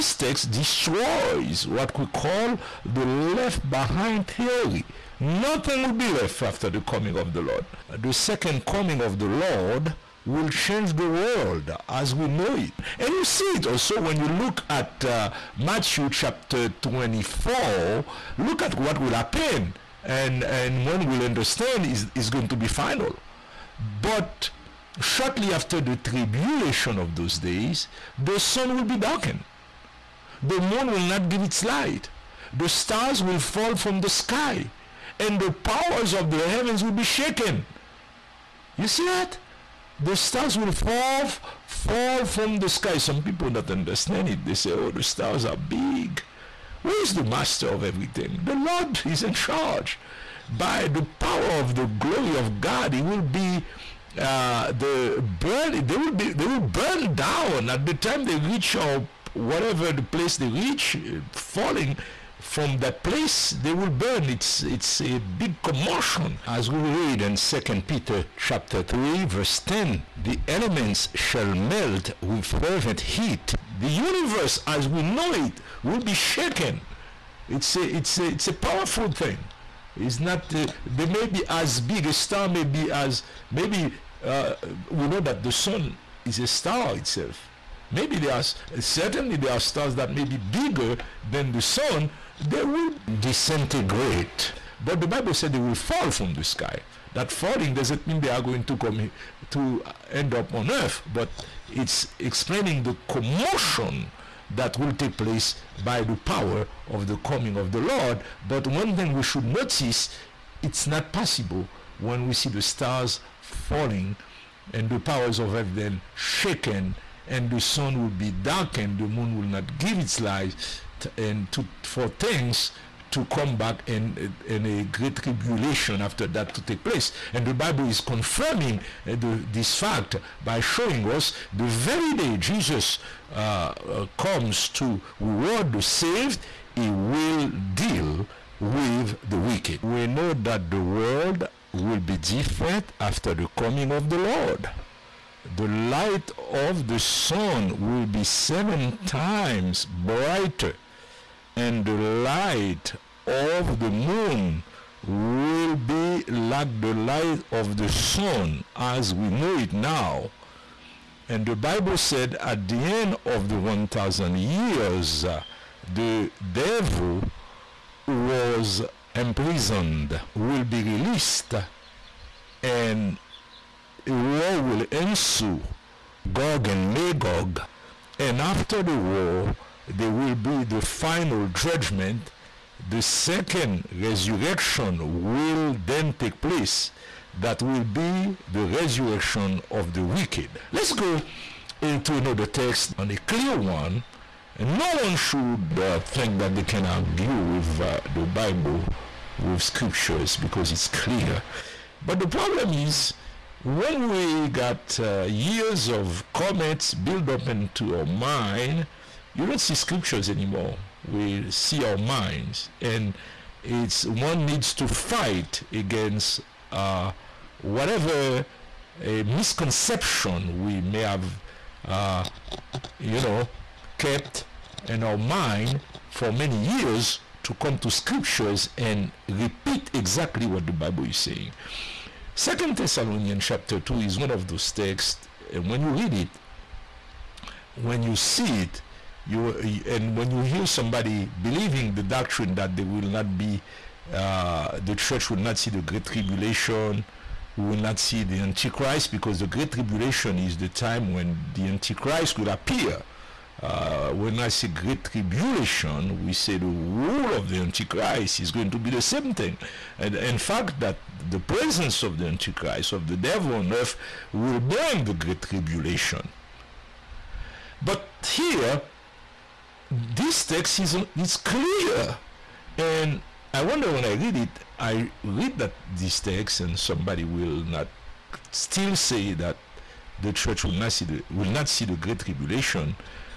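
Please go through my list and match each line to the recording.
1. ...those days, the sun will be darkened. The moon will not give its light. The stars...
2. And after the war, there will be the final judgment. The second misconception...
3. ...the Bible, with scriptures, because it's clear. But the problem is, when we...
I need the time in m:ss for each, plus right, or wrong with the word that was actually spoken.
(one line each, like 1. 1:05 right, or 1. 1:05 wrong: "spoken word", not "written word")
1. 0:27 right
2. 2:58 wrong: "resurrection", not "misconception"
3. 3:18 right.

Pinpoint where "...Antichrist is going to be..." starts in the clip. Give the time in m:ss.
4:17.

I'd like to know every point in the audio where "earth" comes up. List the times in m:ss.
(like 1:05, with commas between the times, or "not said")
1:40, 4:23.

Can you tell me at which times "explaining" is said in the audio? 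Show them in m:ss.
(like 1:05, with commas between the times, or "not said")
1:42.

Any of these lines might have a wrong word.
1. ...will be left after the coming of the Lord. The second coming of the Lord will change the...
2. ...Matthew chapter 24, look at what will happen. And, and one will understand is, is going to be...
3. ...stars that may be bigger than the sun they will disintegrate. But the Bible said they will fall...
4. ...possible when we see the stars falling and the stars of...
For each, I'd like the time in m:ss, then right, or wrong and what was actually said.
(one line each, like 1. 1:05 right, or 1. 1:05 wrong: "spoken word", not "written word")
1. 0:05 right
2. 0:15 right
3. 1:29 right
4. 1:51 wrong: "powers", not "stars".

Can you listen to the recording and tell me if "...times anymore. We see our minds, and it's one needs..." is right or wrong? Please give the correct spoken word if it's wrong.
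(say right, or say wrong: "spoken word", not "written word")
wrong: "scriptures", not "times".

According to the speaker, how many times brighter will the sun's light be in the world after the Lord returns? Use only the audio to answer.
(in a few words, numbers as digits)
7 times.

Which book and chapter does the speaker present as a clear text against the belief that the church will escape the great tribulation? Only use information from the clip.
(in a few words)
2 Thessalonians 2.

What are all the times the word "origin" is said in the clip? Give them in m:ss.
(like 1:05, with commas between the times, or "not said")
not said.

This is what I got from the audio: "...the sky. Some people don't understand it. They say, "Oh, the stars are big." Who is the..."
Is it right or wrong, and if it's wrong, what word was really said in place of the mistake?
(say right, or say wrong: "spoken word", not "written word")
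right.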